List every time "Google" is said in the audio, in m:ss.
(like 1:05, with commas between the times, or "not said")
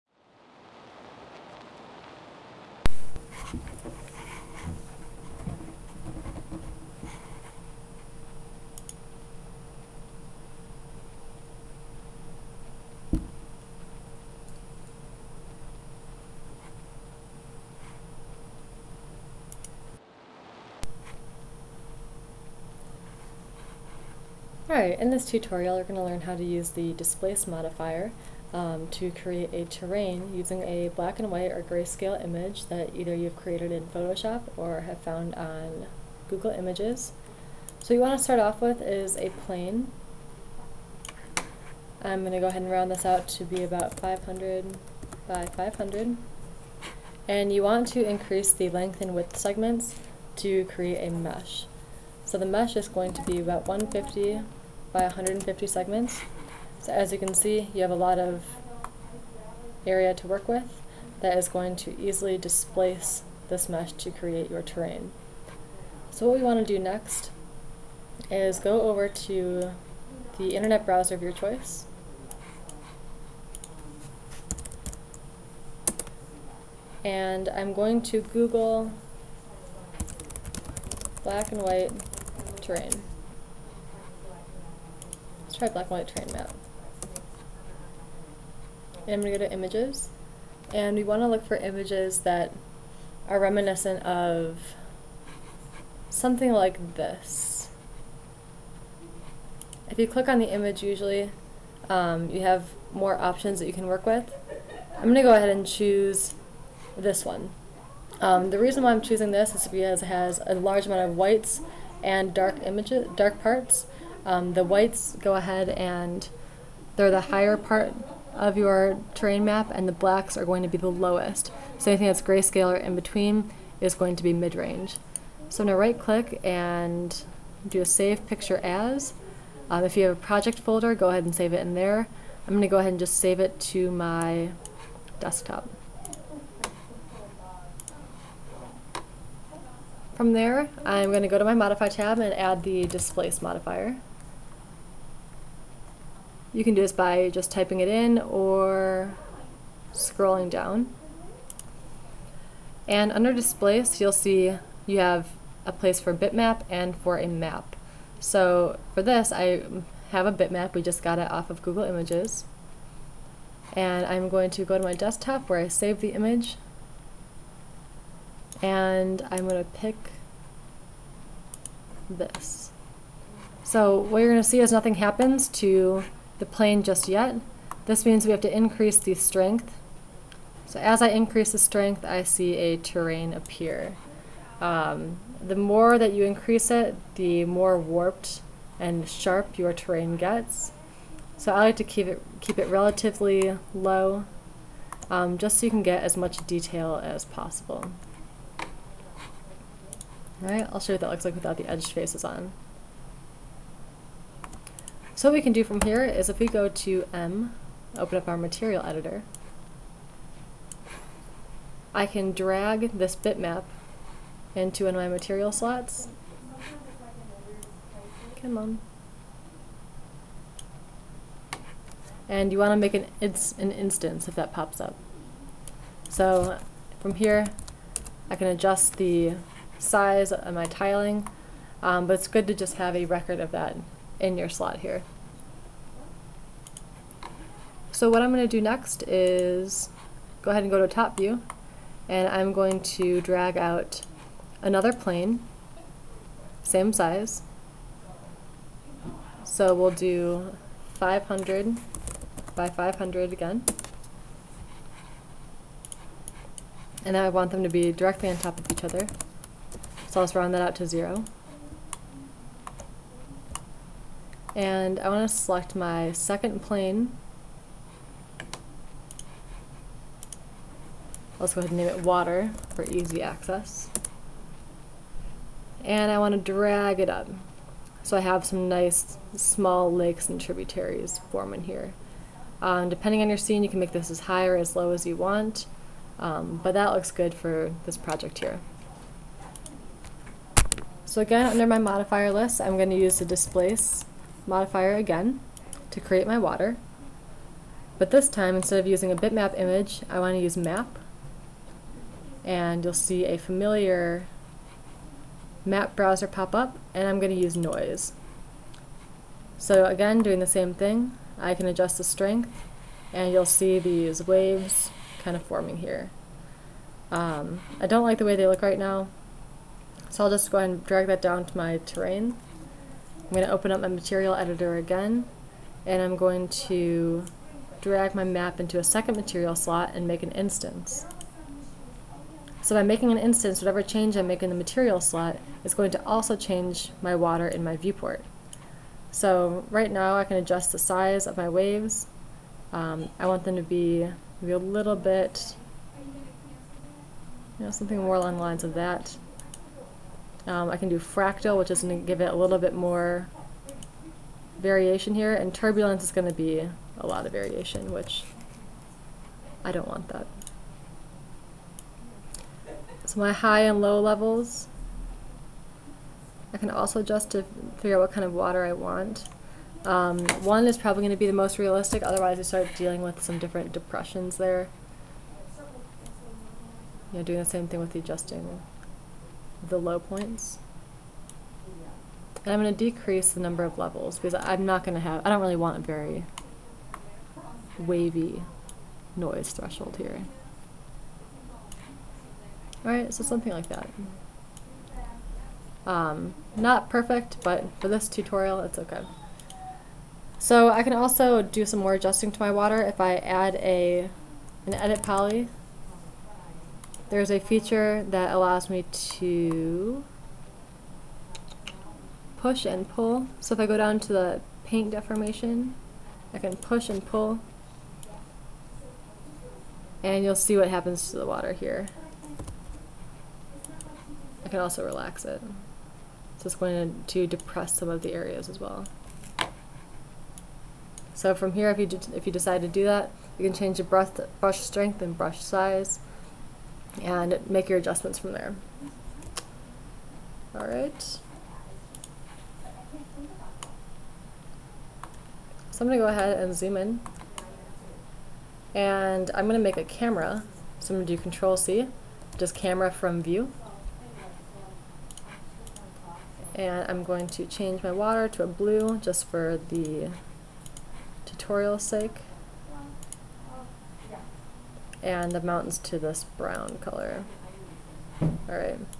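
0:36, 1:18, 2:41.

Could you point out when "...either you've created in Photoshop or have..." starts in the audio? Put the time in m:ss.
0:32.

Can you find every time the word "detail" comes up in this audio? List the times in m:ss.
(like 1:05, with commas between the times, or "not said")
3:16.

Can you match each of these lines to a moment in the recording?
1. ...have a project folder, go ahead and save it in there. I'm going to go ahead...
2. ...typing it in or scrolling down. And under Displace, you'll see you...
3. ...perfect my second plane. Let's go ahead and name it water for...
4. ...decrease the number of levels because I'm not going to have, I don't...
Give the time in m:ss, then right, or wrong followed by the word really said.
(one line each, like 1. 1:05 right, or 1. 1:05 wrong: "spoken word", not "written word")
1. 2:10 right
2. 2:27 right
3. 4:25 wrong: "select", not "perfect"
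4. 6:22 right.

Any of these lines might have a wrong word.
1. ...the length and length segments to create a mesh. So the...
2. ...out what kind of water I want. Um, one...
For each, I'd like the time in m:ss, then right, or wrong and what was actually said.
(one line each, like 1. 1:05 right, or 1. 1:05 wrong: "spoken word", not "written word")
1. 0:48 wrong: "width", not "length"
2. 6:07 right.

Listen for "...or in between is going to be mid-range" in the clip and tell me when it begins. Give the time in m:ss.
2:02.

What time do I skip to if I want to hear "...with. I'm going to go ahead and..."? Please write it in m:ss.
1:44.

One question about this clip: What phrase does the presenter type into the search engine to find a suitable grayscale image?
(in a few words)
black and white terrain map.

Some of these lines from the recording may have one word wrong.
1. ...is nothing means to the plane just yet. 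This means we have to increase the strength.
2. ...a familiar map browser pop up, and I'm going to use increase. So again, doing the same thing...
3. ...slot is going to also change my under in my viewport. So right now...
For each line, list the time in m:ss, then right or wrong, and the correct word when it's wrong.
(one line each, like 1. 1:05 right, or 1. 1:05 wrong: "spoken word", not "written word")
1. 2:54 wrong: "happens", not "means"
2. 5:03 wrong: "noise", not "increase"
3. 5:34 wrong: "water", not "under".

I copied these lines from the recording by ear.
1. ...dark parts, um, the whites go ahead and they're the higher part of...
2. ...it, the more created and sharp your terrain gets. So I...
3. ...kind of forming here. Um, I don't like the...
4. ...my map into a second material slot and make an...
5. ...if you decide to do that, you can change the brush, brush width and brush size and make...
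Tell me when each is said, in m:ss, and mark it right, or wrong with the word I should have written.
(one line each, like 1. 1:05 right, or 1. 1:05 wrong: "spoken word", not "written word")
1. 1:53 right
2. 3:06 wrong: "warped", not "created"
3. 5:15 right
4. 5:28 right
5. 7:12 wrong: "strength", not "width".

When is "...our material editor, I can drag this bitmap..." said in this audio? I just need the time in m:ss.
3:28.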